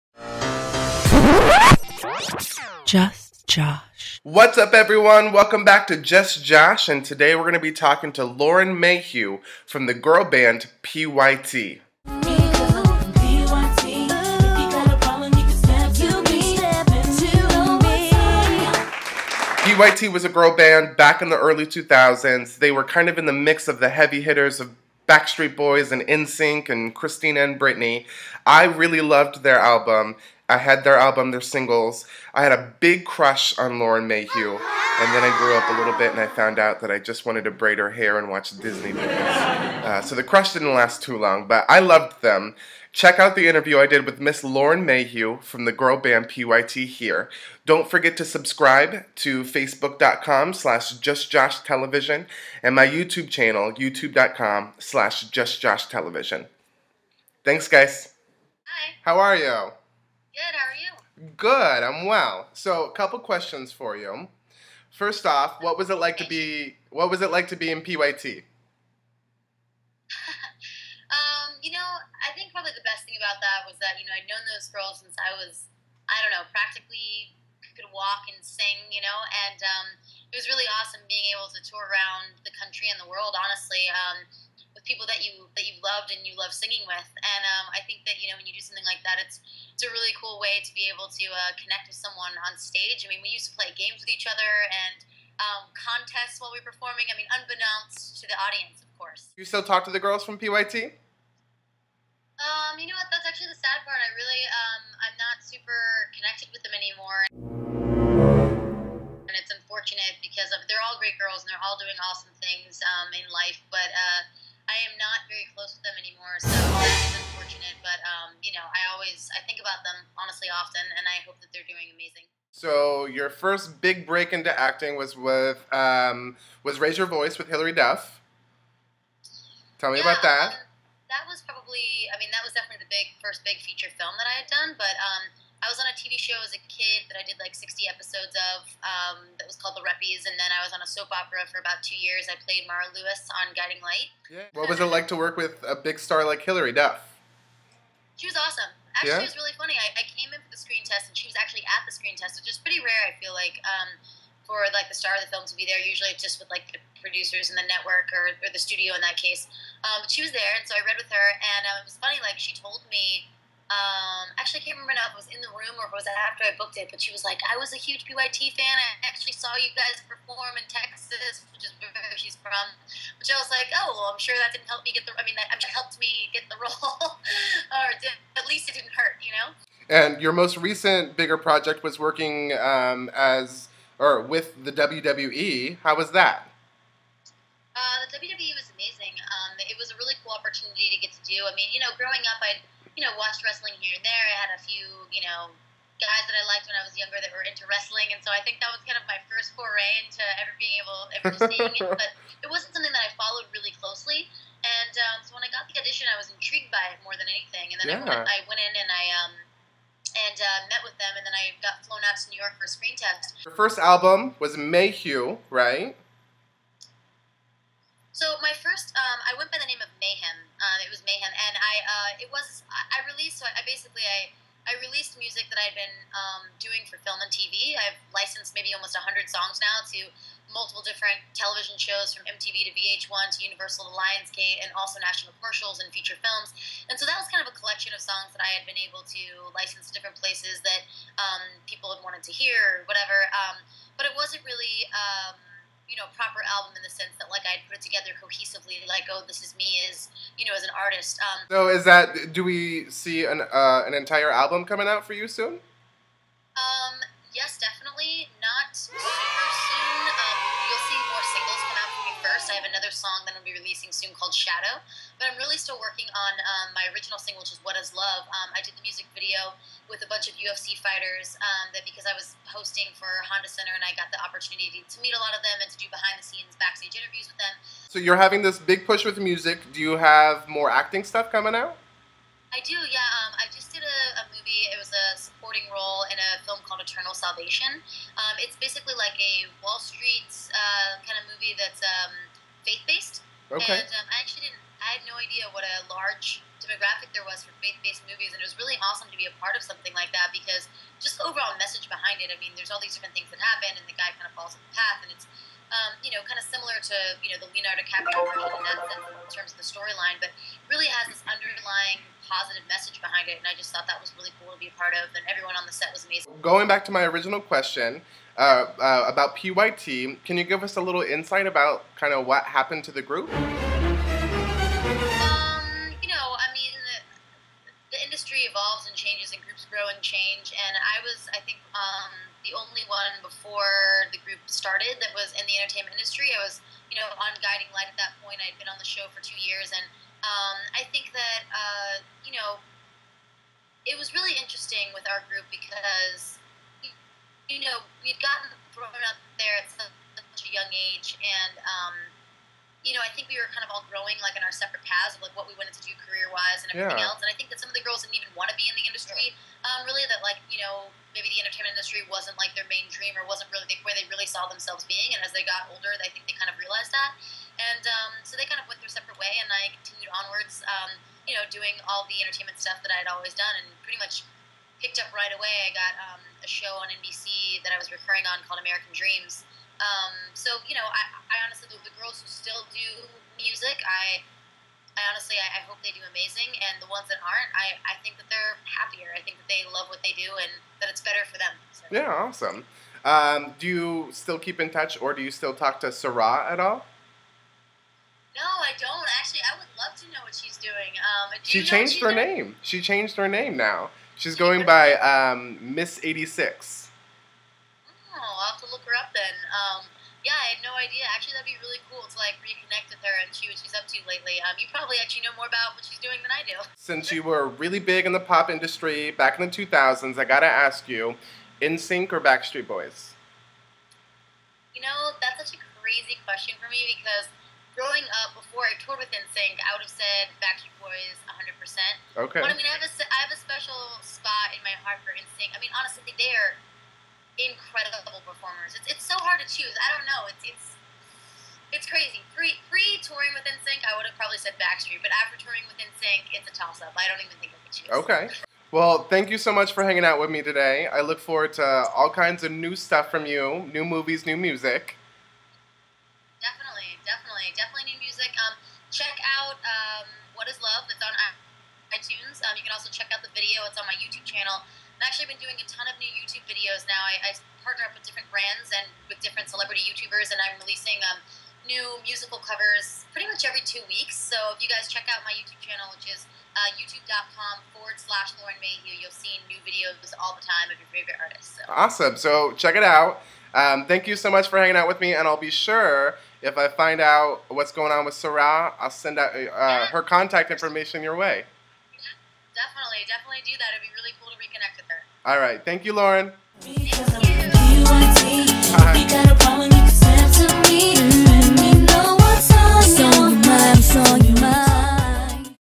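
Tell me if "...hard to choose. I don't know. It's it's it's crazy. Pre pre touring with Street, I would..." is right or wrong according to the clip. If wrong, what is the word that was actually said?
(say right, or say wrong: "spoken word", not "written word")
wrong: "NSYNC", not "Street".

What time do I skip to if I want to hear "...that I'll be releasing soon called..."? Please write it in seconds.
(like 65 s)
263 s.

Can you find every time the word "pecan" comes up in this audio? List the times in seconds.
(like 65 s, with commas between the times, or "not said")
not said.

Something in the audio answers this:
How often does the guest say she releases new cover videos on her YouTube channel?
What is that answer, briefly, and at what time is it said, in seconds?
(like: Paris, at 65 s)
every 2 weeks, at 473 s.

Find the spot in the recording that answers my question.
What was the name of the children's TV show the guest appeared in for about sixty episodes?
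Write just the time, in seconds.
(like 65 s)
139 s.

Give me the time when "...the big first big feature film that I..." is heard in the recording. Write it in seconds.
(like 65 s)
132 s.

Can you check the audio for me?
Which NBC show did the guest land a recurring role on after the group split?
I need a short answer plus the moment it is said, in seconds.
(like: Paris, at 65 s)
American Dreams, at 378 s.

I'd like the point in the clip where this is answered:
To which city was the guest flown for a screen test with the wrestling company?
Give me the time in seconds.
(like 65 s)
212 s.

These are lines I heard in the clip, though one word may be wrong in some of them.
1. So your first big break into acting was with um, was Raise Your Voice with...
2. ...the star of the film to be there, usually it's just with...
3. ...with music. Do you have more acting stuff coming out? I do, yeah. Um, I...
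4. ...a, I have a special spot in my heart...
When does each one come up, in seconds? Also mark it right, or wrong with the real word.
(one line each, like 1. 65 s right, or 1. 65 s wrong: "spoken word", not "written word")
1. 122 s right
2. 154 s right
3. 279 s right
4. 432 s right.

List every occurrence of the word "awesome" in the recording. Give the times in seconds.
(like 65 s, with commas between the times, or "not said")
80 s, 112 s, 148 s, 298 s, 392 s, 481 s.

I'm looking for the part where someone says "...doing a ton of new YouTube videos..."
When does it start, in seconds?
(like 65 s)
465 s.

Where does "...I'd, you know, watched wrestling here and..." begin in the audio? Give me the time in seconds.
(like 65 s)
192 s.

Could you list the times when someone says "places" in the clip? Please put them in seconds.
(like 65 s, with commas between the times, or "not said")
240 s.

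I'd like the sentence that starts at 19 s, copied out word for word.
PYT was a girl band back in the early 2000s.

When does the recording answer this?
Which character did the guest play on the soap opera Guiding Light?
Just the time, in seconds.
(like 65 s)
142 s.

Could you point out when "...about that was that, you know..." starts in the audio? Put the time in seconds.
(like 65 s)
73 s.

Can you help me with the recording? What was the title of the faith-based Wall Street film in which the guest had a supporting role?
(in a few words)
Eternal Salvation.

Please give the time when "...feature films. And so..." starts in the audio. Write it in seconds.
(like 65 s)
235 s.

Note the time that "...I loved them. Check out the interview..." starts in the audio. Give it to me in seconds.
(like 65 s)
41 s.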